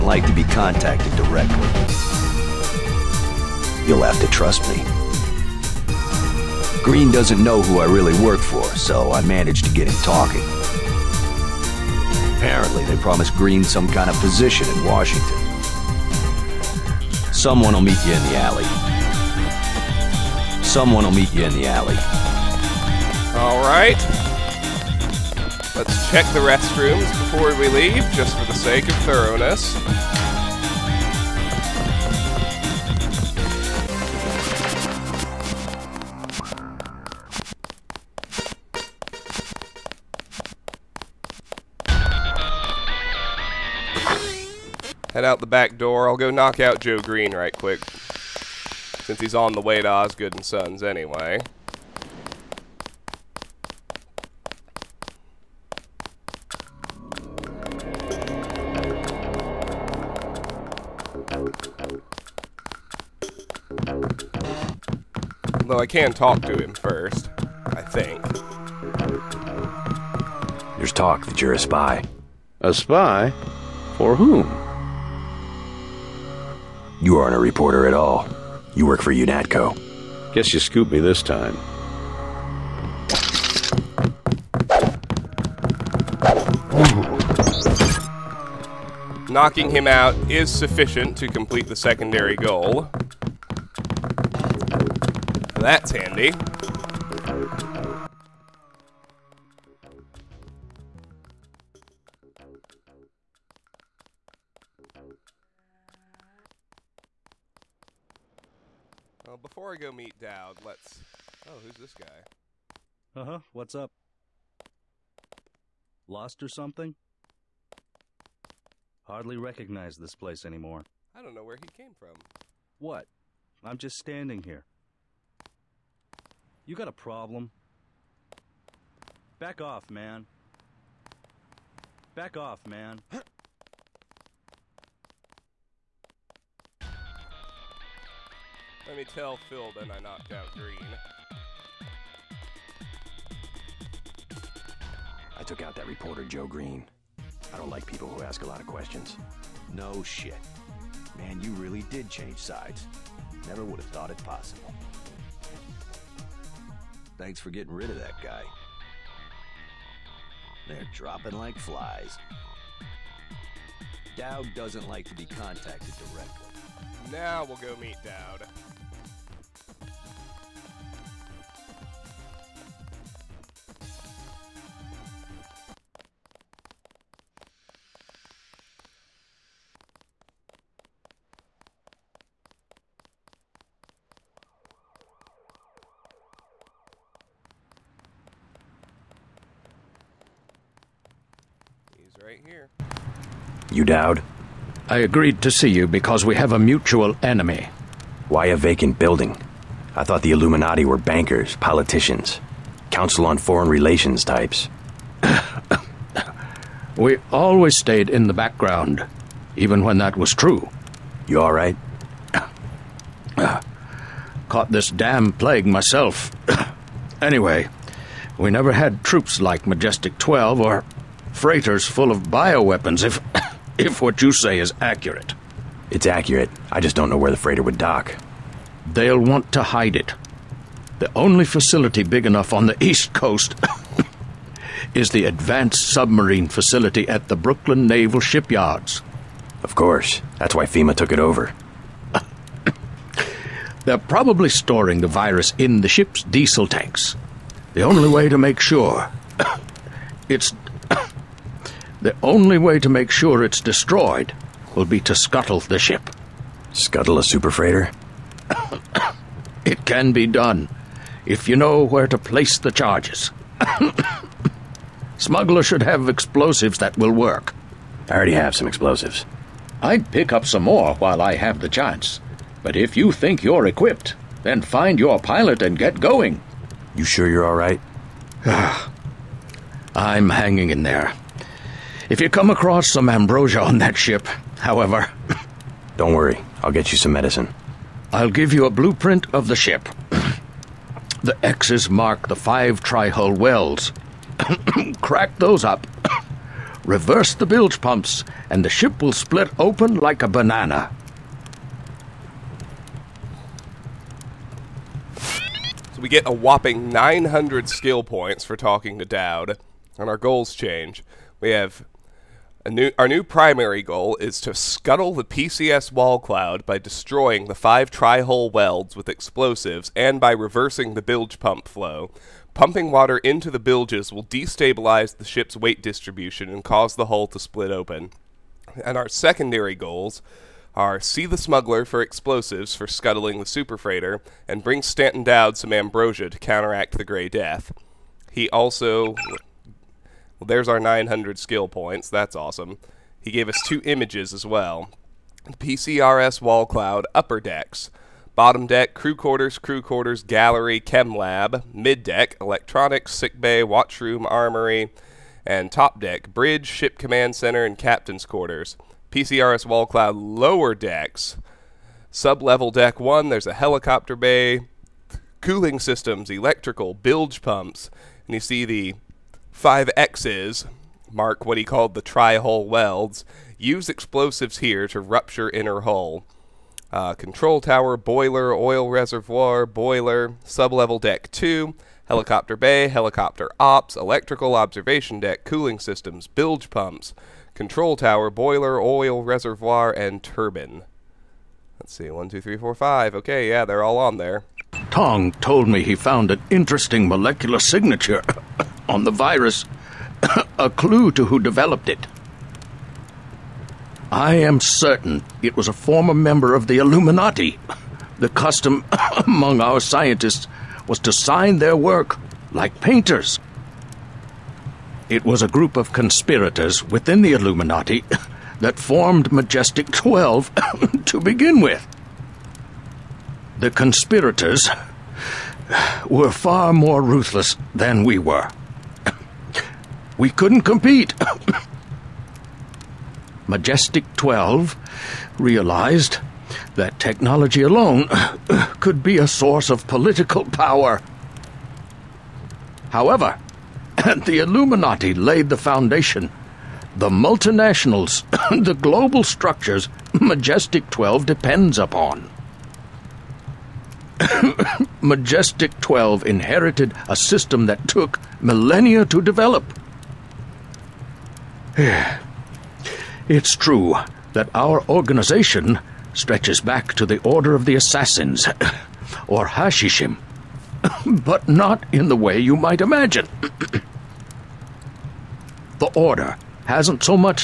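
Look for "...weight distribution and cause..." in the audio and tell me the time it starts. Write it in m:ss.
5:25.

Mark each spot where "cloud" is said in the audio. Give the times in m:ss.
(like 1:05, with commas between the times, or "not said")
5:16, 5:46, 5:59.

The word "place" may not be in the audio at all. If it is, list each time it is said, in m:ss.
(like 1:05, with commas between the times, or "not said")
2:00, 4:22.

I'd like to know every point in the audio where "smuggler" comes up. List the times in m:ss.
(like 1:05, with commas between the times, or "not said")
4:25, 5:31.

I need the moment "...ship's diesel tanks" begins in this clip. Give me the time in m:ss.
4:05.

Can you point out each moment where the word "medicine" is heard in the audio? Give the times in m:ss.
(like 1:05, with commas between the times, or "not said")
4:47.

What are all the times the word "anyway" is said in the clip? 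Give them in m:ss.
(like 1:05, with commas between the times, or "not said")
0:50, 3:37.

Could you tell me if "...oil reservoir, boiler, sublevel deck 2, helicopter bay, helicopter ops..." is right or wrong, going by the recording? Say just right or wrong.
right.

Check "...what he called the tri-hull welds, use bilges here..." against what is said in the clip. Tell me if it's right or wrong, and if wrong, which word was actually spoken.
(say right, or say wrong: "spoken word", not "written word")
wrong: "explosives", not "bilges".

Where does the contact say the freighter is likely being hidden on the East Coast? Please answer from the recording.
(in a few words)
Brooklyn Naval Shipyards.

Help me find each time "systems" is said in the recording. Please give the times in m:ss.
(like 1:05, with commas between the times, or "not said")
6:05, 6:25, 7:37.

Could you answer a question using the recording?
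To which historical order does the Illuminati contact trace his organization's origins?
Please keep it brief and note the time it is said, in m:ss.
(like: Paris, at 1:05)
Order of the Assassins, at 7:47.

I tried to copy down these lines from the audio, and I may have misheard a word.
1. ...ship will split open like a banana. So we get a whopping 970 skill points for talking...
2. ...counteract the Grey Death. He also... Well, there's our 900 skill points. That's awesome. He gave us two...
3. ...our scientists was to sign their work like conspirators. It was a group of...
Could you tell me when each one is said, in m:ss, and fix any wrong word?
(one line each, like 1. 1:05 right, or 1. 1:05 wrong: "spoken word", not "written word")
1. 4:58 wrong: "900", not "970"
2. 5:36 right
3. 6:49 wrong: "painters", not "conspirators".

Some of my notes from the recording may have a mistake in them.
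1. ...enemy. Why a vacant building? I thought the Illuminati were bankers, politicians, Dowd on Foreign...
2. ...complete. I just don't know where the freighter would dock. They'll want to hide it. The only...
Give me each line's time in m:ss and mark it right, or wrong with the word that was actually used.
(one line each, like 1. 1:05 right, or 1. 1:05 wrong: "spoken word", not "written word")
1. 3:17 wrong: "Council", not "Dowd"
2. 3:46 wrong: "accurate", not "complete".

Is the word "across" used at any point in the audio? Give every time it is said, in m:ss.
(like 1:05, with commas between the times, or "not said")
4:42.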